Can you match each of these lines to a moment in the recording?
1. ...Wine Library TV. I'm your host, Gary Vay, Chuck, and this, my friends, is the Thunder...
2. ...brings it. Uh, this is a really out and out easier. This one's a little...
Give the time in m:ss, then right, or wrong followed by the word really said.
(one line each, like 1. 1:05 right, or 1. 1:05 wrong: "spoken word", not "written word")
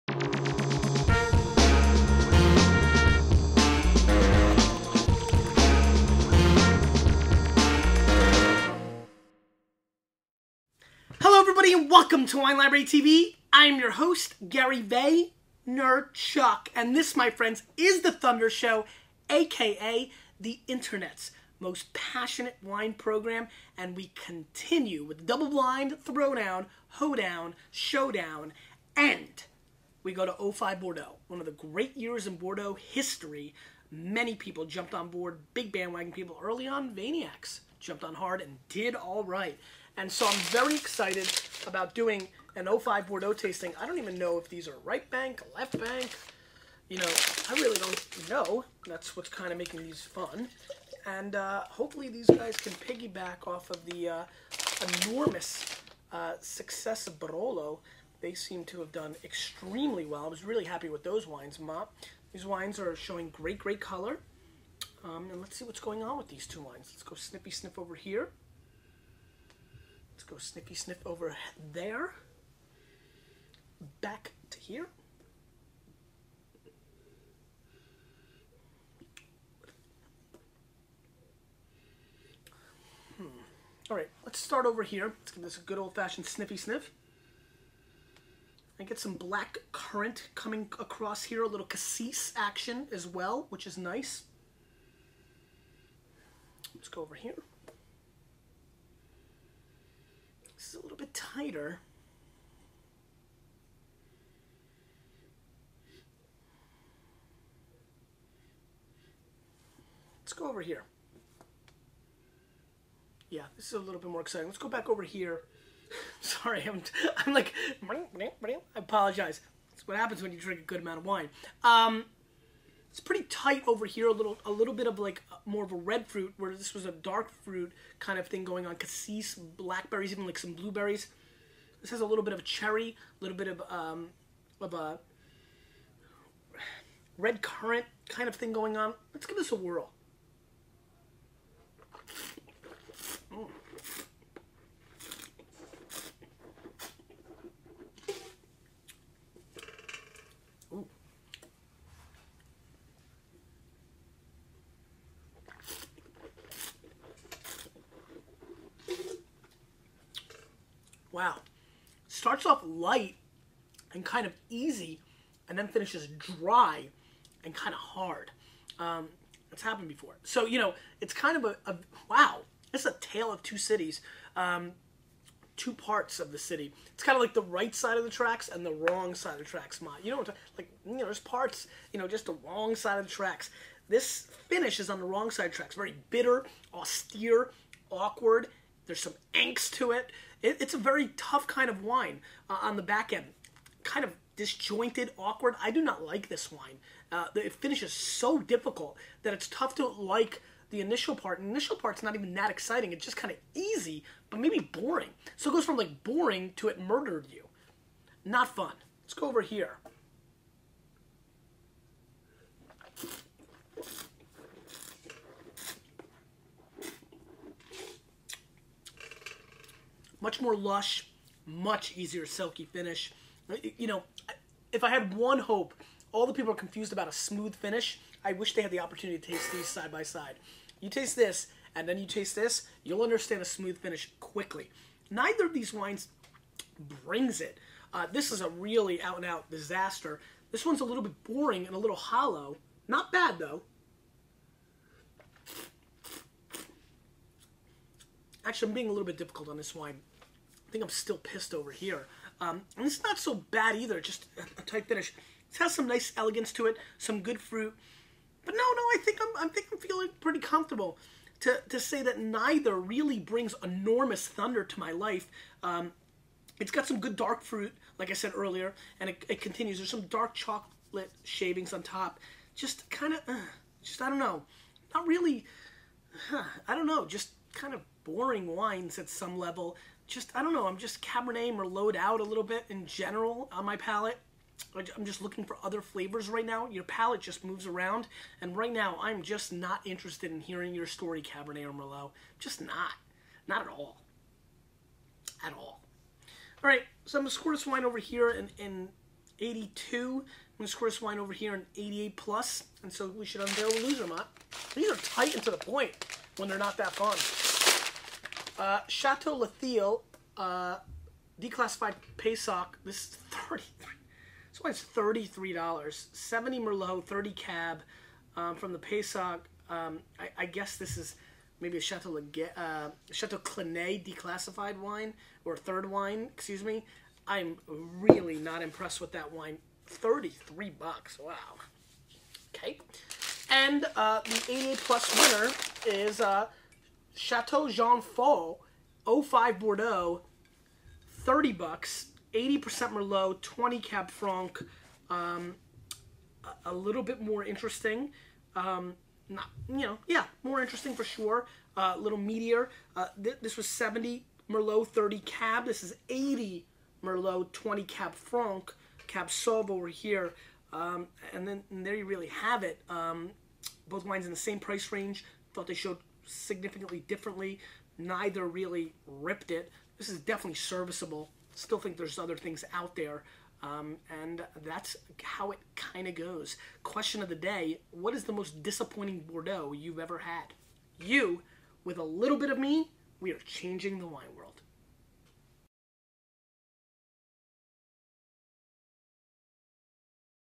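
1. 0:12 right
2. 3:57 wrong: "disaster", not "easier".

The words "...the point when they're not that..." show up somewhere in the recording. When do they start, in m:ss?
5:05.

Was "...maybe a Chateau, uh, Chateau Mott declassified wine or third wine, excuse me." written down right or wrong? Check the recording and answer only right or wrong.
wrong.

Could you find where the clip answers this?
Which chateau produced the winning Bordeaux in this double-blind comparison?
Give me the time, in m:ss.
5:37.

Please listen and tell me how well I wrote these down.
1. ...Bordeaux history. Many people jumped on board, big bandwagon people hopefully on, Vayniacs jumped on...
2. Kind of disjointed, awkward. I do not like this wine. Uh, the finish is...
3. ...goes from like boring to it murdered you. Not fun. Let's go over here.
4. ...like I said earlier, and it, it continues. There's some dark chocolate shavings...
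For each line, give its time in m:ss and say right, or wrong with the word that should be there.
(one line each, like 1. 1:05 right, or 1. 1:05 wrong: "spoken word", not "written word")
1. 0:32 wrong: "early", not "hopefully"
2. 3:13 right
3. 3:25 right
4. 4:27 right.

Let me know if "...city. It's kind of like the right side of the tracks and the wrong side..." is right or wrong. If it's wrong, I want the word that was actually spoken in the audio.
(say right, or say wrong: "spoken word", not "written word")
right.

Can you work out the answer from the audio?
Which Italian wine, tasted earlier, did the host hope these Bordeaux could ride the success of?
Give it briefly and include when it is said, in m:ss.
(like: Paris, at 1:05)
Barolo, at 0:57.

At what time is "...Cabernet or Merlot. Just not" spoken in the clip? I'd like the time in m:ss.
4:51.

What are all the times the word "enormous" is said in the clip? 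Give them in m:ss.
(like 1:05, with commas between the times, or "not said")
0:55, 4:23.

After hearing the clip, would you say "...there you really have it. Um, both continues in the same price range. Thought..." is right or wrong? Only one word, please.
wrong.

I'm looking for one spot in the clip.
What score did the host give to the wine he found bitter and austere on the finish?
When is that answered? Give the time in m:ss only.
4:59.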